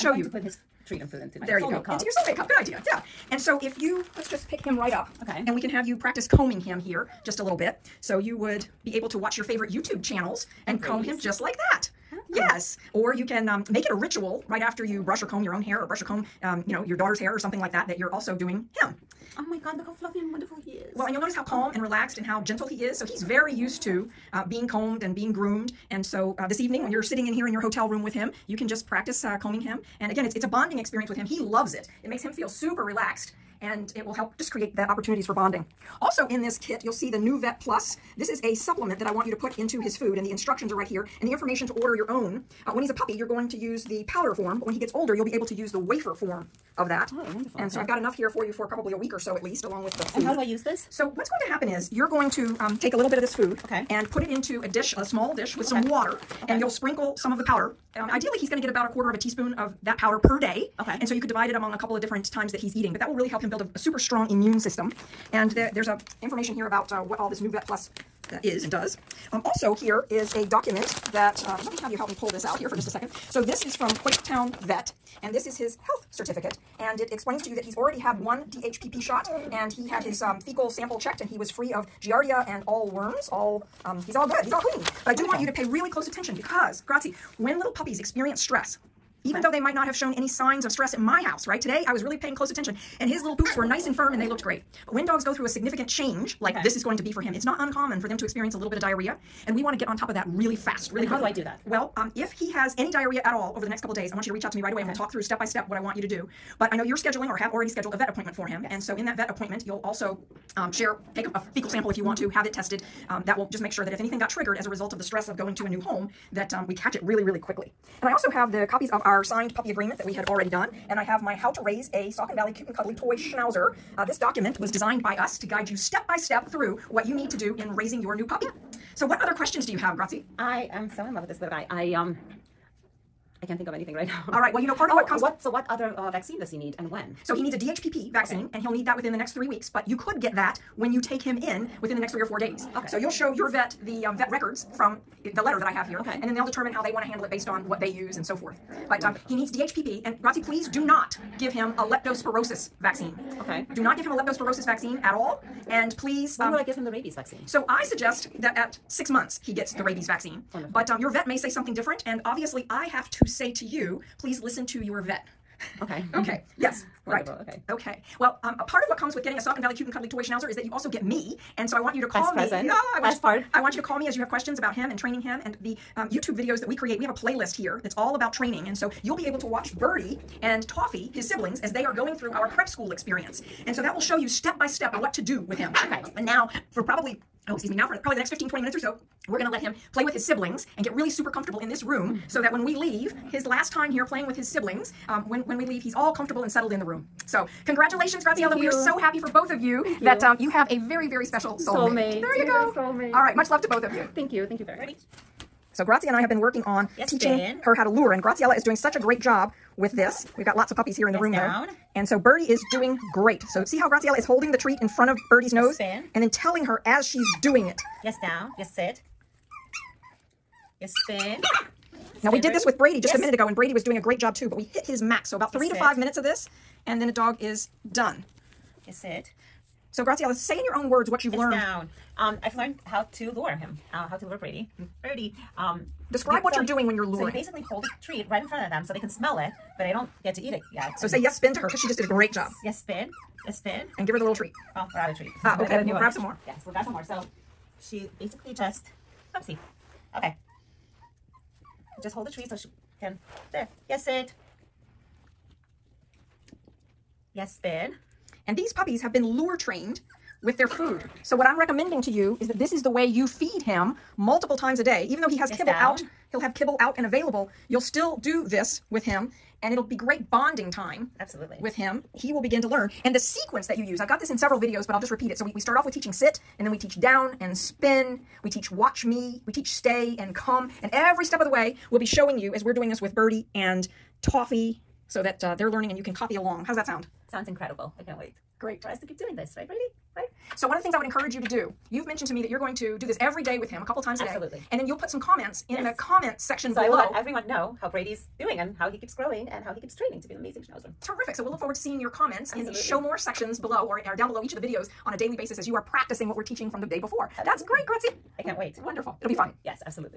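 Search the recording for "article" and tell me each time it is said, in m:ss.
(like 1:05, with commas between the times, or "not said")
not said.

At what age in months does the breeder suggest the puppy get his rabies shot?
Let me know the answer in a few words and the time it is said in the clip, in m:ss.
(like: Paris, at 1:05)
6, at 2:38.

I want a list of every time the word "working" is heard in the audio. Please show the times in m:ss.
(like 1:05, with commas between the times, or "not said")
3:26.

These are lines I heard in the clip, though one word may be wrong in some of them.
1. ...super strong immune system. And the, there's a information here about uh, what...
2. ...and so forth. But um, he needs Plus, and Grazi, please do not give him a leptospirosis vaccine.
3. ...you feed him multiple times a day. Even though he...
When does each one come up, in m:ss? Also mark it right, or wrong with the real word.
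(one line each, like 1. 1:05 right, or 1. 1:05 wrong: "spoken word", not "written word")
1. 1:03 right
2. 2:28 wrong: "DHPP", not "Plus"
3. 4:23 right.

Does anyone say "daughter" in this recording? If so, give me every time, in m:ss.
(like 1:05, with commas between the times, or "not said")
0:16.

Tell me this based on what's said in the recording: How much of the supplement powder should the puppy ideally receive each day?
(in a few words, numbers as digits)
1/4 teaspoon.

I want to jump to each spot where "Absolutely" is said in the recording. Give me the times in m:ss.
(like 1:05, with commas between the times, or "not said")
4:31, 4:54, 5:02, 5:07.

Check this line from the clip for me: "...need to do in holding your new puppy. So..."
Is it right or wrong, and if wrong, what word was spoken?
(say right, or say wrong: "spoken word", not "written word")
wrong: "raising", not "holding".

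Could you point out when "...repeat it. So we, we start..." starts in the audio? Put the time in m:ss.
4:35.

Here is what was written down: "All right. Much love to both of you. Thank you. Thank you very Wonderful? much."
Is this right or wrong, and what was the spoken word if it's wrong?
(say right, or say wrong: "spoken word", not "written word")
wrong: "Ready", not "Wonderful".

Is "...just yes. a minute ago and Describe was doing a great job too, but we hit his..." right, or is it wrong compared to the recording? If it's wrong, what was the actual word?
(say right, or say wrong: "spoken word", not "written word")
wrong: "Brady", not "Describe".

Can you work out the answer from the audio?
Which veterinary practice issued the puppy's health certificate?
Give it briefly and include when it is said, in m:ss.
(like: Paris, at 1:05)
Quakertown Vet, at 1:13.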